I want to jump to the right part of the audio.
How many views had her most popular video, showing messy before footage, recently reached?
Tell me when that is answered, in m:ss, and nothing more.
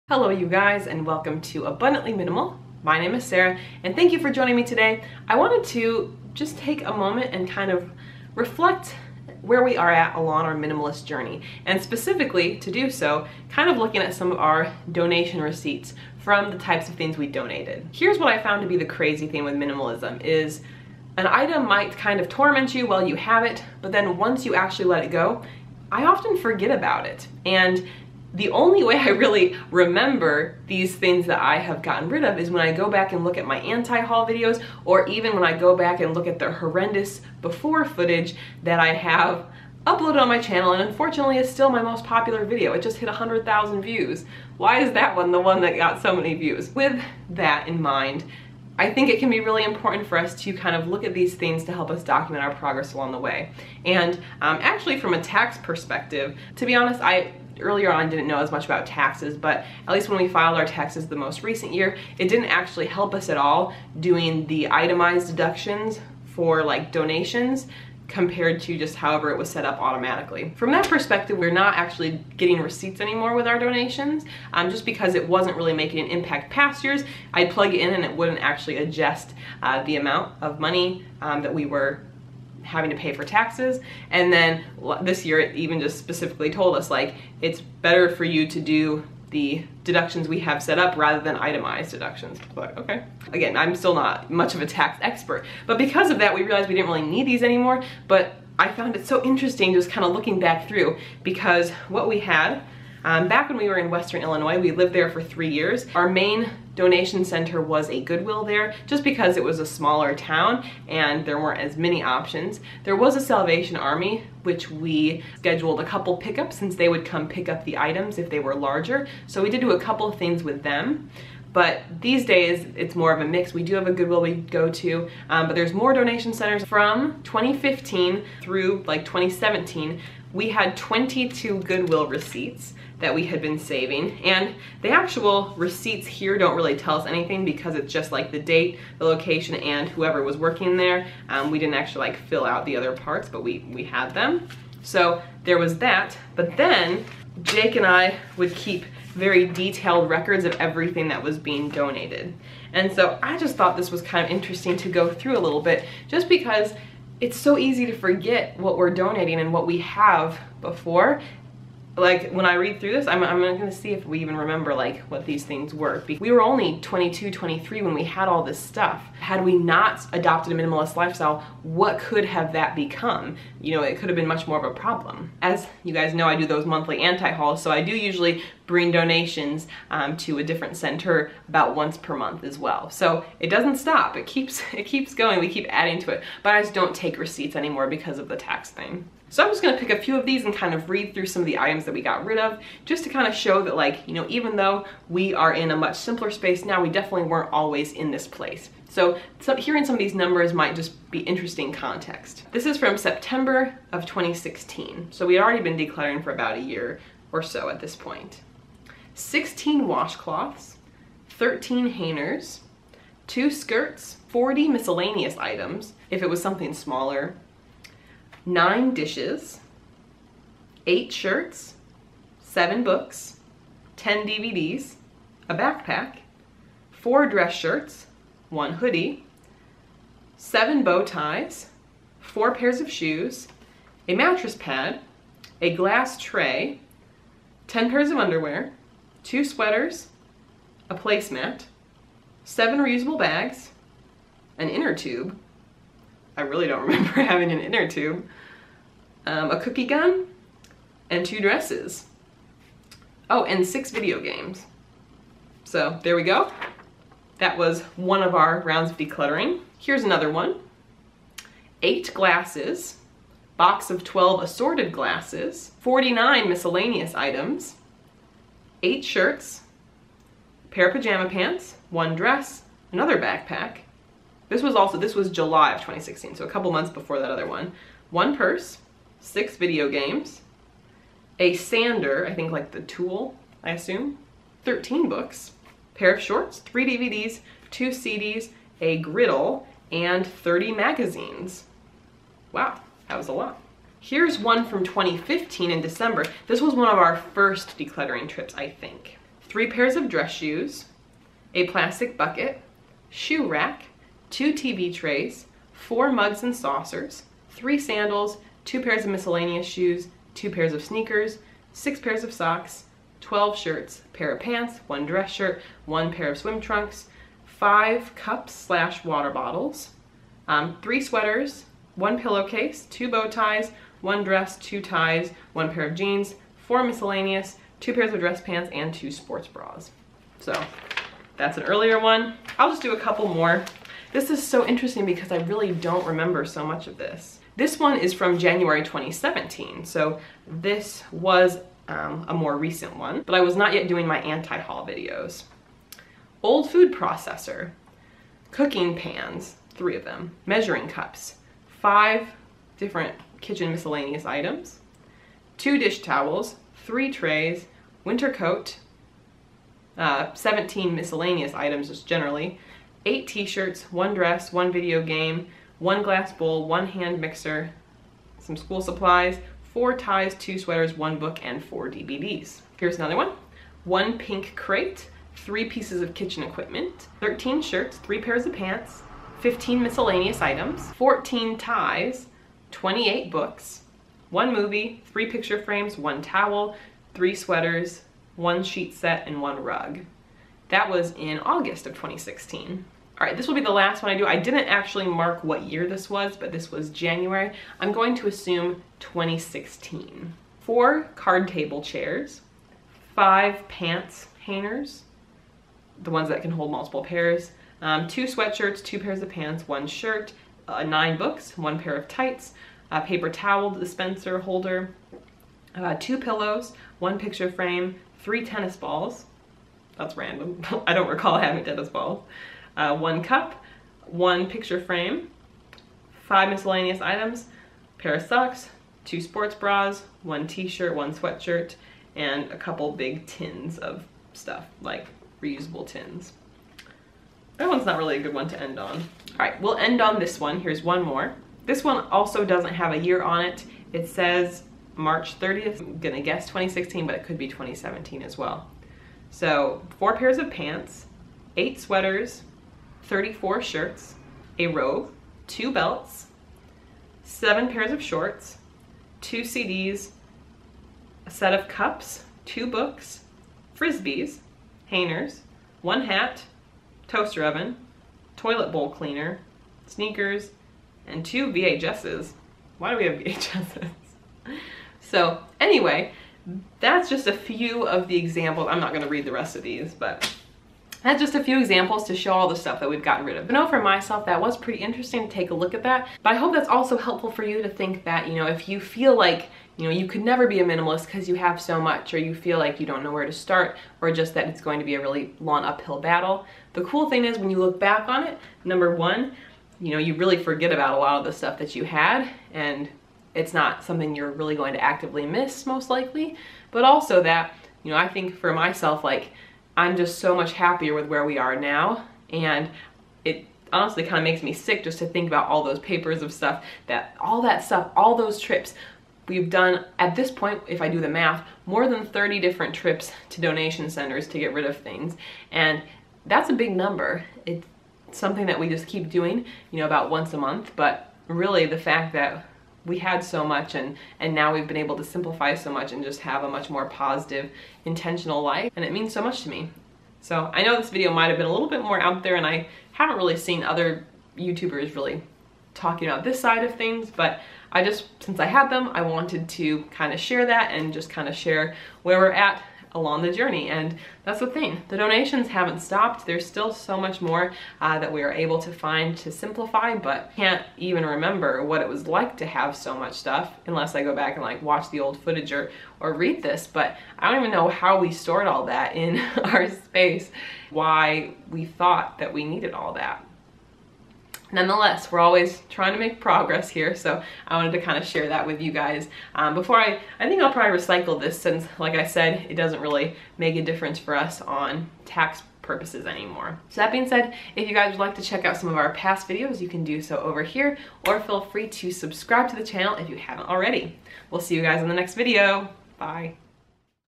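0:43.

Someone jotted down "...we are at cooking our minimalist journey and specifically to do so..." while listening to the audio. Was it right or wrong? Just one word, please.
wrong.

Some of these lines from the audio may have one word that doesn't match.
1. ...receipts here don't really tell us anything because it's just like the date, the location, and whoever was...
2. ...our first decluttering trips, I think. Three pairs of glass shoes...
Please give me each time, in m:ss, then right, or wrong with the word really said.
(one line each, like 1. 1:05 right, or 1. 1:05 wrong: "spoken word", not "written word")
1. 2:15 right
2. 4:56 wrong: "dress", not "glass".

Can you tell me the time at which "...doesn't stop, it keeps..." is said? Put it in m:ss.
3:03.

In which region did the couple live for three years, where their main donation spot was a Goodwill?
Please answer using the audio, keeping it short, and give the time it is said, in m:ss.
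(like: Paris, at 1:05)
Western Illinois, at 1:43.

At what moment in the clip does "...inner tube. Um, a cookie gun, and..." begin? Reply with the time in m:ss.
4:07.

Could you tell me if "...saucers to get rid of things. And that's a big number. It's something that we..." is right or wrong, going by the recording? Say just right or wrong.
wrong.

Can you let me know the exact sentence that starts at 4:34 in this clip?
This was also, this was July of 2016, so a couple months before that other one.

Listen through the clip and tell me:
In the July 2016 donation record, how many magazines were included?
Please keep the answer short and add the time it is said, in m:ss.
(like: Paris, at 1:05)
30, at 4:50.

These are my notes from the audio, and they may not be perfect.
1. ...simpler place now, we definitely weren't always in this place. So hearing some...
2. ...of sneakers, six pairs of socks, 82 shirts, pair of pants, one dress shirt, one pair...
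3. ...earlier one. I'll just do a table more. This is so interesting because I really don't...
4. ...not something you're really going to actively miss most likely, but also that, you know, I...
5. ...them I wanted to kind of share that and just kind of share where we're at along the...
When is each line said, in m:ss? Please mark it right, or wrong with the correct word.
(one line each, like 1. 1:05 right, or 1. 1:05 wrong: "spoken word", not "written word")
1. 3:15 wrong: "space", not "place"
2. 5:10 wrong: "12", not "82"
3. 5:31 wrong: "couple", not "table"
4. 8:23 right
5. 9:08 right.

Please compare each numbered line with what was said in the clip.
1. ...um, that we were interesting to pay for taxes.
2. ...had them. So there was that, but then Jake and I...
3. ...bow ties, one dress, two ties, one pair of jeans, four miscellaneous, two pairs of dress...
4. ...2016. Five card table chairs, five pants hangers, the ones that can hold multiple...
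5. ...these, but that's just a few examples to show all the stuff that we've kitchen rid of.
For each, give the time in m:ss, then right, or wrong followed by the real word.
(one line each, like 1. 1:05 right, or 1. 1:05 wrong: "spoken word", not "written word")
1. 1:21 wrong: "having", not "interesting"
2. 2:23 right
3. 5:23 right
4. 6:38 wrong: "Four", not "Five"
5. 7:59 wrong: "gotten", not "kitchen".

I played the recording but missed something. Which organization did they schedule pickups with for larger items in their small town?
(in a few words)
Salvation Army.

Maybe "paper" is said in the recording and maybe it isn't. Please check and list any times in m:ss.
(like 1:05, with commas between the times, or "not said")
6:53, 8:35.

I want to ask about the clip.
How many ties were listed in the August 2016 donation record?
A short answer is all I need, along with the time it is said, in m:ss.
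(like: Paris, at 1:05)
14, at 6:20.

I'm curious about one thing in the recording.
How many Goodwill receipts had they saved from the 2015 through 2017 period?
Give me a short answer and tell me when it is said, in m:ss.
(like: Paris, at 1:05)
22, at 2:10.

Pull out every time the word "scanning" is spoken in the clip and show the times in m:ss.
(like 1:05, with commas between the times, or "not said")
not said.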